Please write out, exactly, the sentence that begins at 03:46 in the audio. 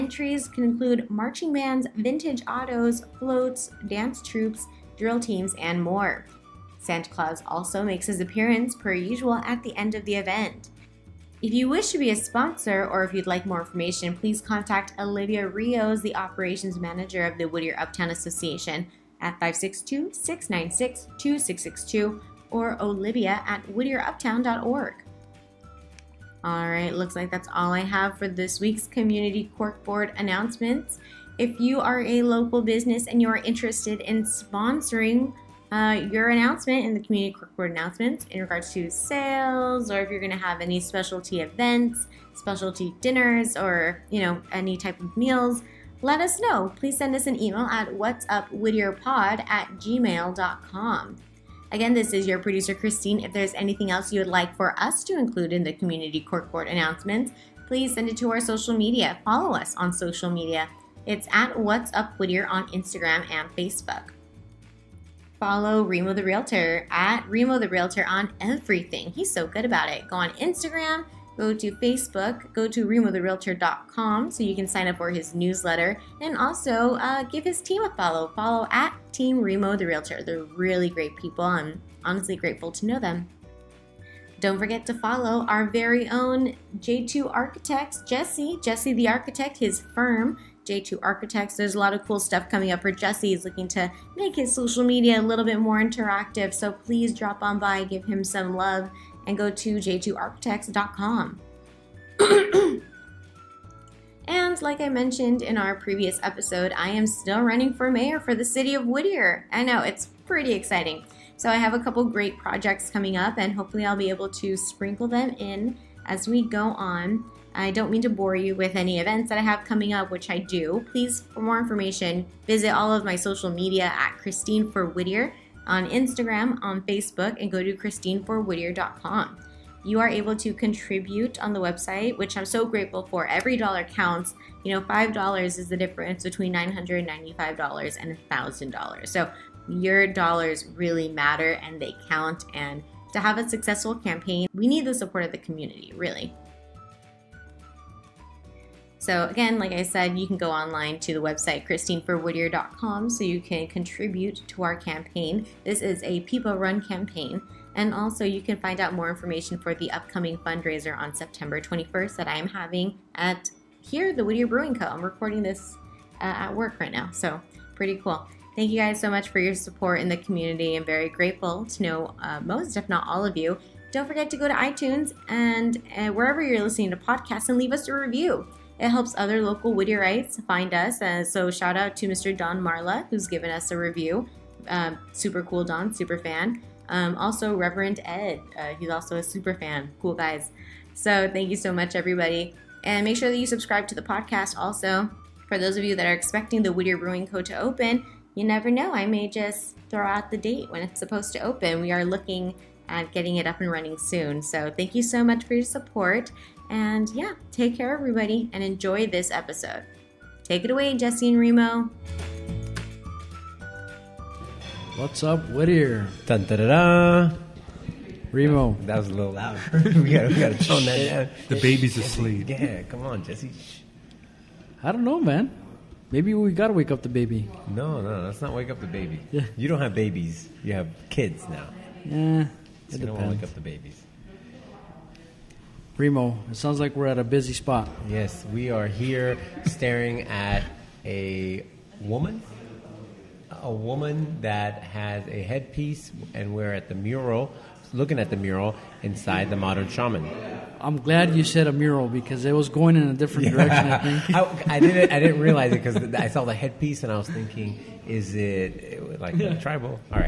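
Maybe we gotta wake up the baby.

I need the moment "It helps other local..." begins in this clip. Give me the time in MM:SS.
02:58.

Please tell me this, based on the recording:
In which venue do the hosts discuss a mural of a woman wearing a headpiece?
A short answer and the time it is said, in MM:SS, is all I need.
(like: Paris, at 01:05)
The Modern Shaman, at 04:09.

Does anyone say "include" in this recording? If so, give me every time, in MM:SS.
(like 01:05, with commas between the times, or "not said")
00:00, 00:55.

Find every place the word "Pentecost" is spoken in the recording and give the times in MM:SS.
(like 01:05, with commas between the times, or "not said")
not said.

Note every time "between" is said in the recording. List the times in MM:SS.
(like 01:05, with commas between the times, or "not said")
02:16.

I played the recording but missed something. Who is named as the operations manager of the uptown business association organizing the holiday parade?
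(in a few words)
Olivia Rios.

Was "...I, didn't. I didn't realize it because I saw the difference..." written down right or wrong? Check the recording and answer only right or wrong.
wrong.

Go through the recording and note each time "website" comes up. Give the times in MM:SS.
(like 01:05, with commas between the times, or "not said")
02:11, 02:31.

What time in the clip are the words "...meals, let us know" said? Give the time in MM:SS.
00:45.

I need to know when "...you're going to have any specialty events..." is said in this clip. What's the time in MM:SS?
00:40.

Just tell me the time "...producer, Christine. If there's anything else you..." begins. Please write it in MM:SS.
00:52.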